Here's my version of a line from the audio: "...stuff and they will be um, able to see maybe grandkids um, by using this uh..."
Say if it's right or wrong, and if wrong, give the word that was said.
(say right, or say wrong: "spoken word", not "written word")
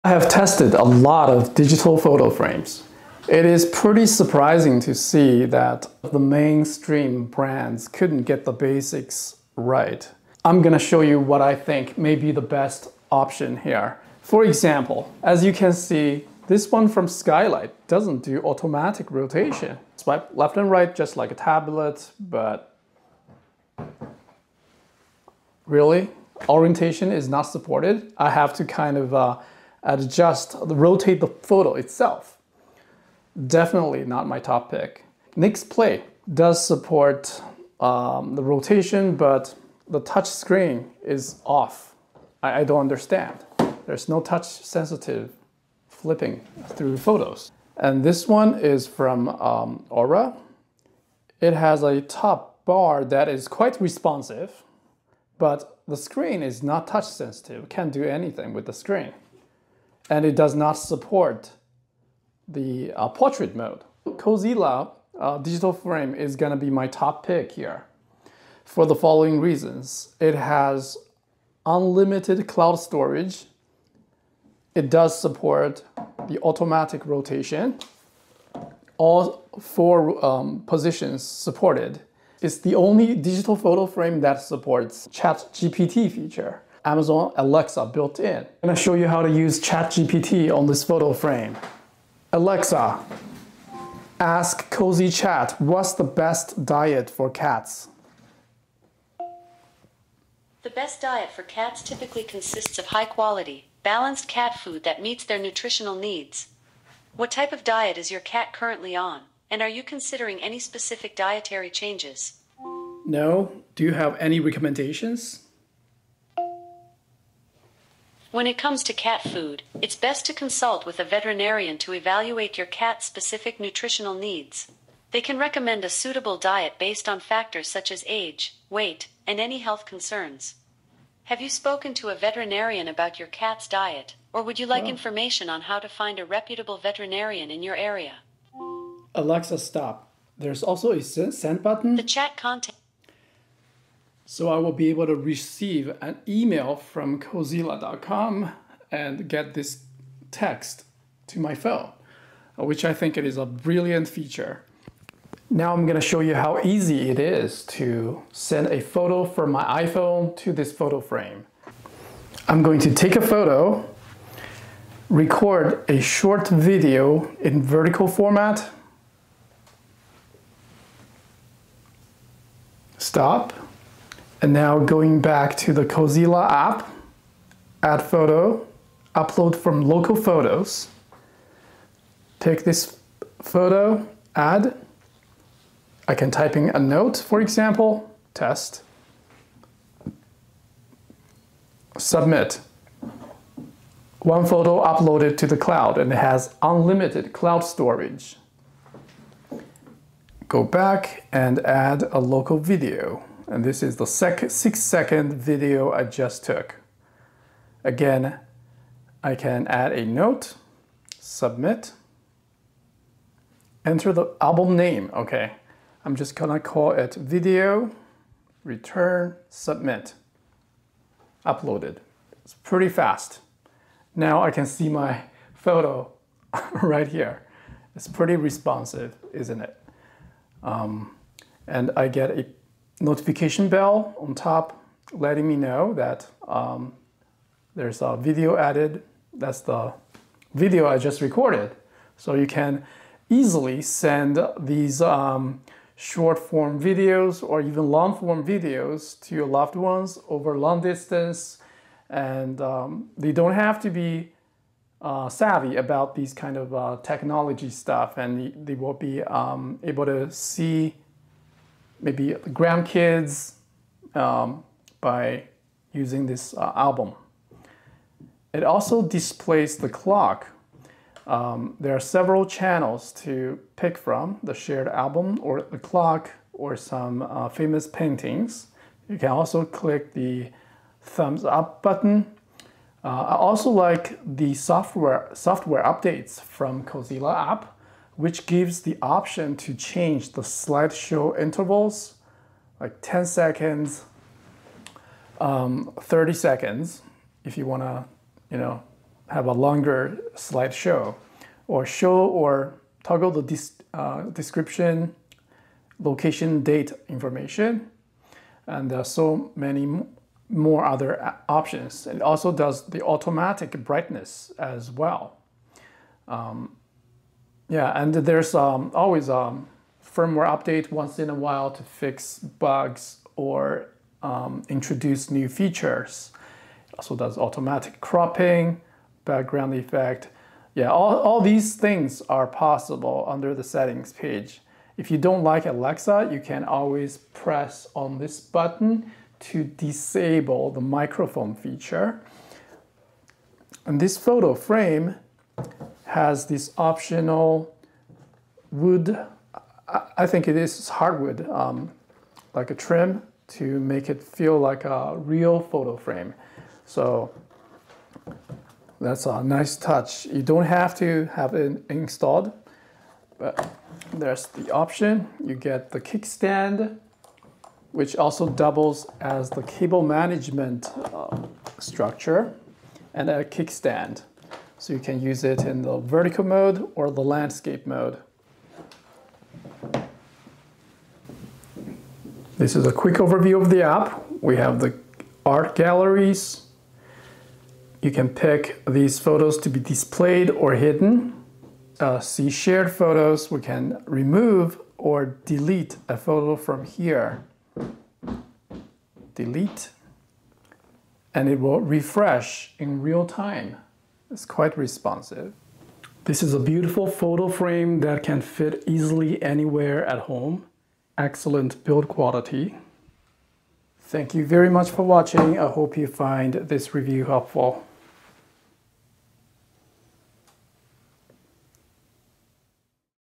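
right.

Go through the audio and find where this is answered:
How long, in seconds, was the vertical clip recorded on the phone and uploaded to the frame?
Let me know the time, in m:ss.
3:24.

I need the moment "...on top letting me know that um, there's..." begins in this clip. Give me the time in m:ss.
3:54.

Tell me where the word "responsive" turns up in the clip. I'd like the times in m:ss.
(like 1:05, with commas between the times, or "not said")
0:53, 3:48, 6:44.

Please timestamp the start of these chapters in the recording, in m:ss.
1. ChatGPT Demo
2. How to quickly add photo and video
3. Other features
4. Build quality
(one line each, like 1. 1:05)
1. 1:31
2. 2:35
3. 4:23
4. 6:44.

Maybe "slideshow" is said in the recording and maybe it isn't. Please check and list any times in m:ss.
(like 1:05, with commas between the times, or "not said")
4:50, 5:00.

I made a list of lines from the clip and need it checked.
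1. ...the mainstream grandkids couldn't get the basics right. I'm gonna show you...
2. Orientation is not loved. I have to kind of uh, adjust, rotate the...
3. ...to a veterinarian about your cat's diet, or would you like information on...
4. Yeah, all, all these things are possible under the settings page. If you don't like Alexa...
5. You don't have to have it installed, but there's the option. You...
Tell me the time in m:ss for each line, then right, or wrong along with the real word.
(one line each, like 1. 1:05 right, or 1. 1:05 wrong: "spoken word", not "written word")
1. 0:06 wrong: "brands", not "grandkids"
2. 0:26 wrong: "supported", not "loved"
3. 2:11 right
4. 5:30 right
5. 6:00 right.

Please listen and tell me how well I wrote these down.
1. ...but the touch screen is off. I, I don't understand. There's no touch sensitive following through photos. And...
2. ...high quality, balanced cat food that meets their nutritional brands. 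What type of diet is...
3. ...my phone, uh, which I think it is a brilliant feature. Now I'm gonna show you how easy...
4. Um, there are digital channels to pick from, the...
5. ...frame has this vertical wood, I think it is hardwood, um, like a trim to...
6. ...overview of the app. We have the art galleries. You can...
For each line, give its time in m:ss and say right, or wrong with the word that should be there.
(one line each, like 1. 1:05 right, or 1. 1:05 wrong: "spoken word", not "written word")
1. 0:39 wrong: "flipping", not "following"
2. 1:42 wrong: "needs", not "brands"
3. 2:31 right
4. 4:31 wrong: "several", not "digital"
5. 5:44 wrong: "optional", not "vertical"
6. 6:23 right.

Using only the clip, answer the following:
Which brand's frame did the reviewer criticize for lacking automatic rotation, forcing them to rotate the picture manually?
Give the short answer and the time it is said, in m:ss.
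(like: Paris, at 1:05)
Skylight, at 0:17.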